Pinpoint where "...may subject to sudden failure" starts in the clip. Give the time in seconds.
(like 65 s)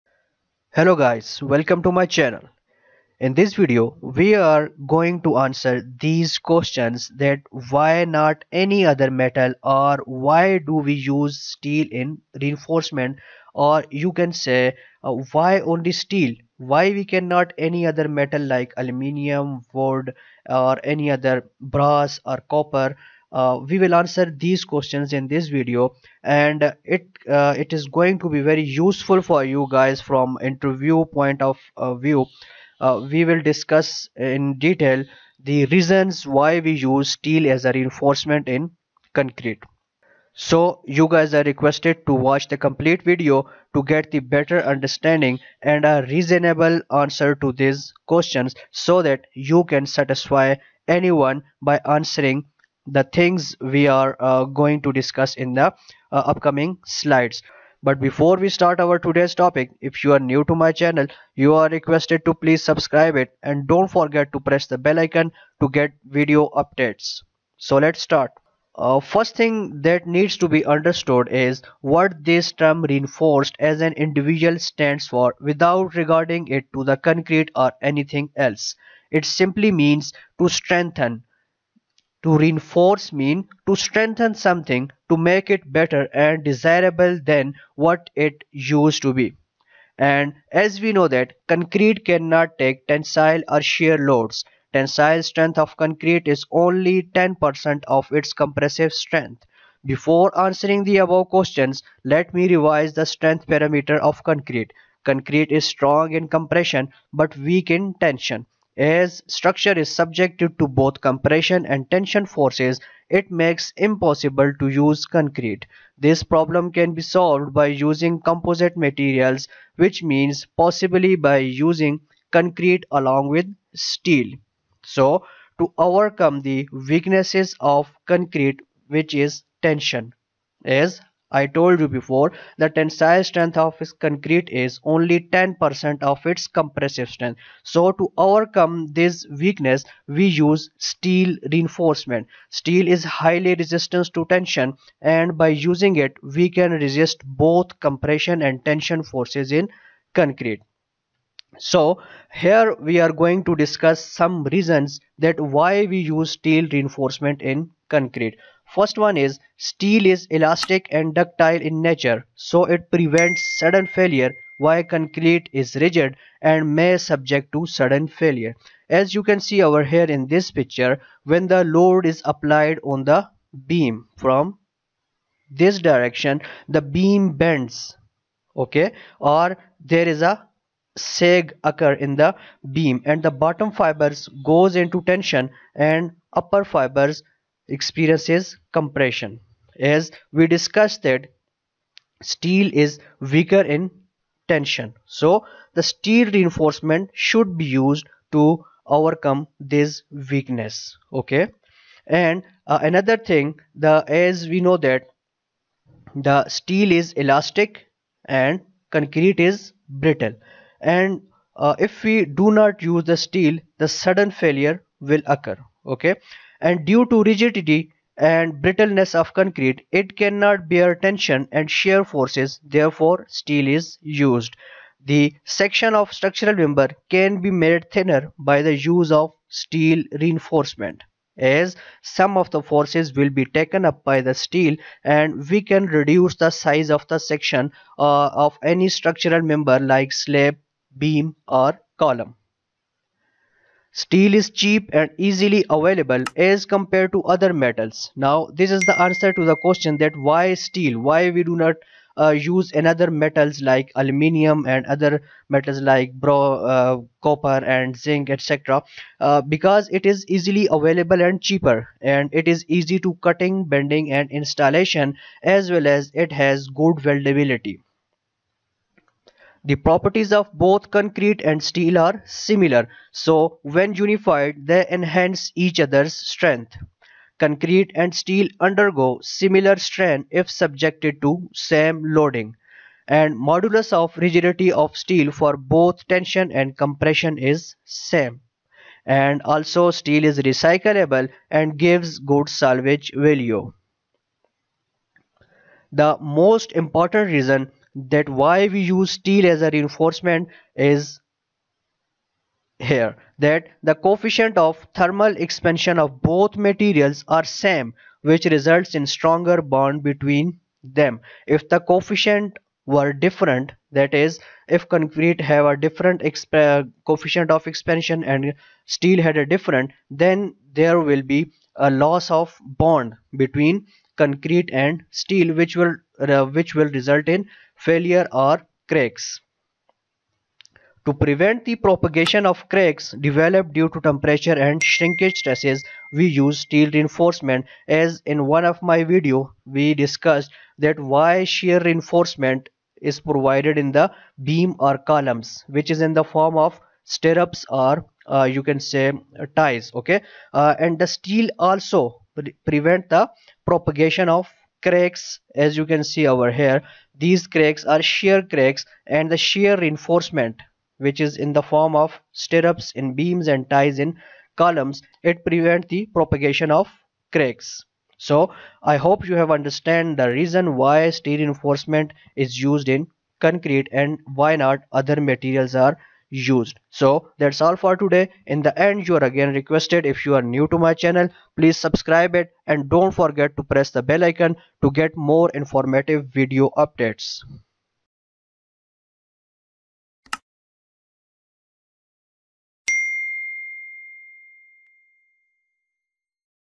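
166 s.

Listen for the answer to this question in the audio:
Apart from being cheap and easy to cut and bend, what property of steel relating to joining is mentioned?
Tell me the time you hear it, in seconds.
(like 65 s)
266 s.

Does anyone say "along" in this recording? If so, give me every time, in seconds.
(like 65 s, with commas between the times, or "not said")
122 s.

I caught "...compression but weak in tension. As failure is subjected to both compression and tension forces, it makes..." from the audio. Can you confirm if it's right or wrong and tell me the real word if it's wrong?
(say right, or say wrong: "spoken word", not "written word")
wrong: "structure", not "failure".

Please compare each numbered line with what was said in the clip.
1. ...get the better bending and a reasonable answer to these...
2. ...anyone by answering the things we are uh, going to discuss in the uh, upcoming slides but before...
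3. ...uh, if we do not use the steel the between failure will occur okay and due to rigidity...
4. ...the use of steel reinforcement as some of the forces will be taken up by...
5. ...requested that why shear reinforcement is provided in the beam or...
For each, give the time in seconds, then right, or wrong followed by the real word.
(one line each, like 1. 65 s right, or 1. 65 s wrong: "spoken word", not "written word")
1. 43 s wrong: "understanding", not "bending"
2. 50 s right
3. 211 s wrong: "sudden", not "between"
4. 228 s right
5. 339 s wrong: "discussed", not "requested".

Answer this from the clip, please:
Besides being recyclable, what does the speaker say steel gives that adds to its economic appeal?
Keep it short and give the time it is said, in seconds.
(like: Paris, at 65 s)
good salvage value, at 292 s.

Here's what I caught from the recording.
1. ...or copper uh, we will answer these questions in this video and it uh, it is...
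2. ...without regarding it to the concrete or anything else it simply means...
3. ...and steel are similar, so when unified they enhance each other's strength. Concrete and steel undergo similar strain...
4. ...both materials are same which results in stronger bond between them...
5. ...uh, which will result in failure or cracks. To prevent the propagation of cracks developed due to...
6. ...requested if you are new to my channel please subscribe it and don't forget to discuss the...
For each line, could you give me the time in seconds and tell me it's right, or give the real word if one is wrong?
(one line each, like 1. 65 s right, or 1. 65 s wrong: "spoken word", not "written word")
1. 22 s right
2. 75 s right
3. 271 s right
4. 306 s right
5. 326 s right
6. 379 s wrong: "press", not "discuss".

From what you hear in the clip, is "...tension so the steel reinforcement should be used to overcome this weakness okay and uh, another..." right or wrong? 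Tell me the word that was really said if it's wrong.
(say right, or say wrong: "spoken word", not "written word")
right.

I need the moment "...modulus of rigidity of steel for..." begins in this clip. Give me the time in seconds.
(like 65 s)
283 s.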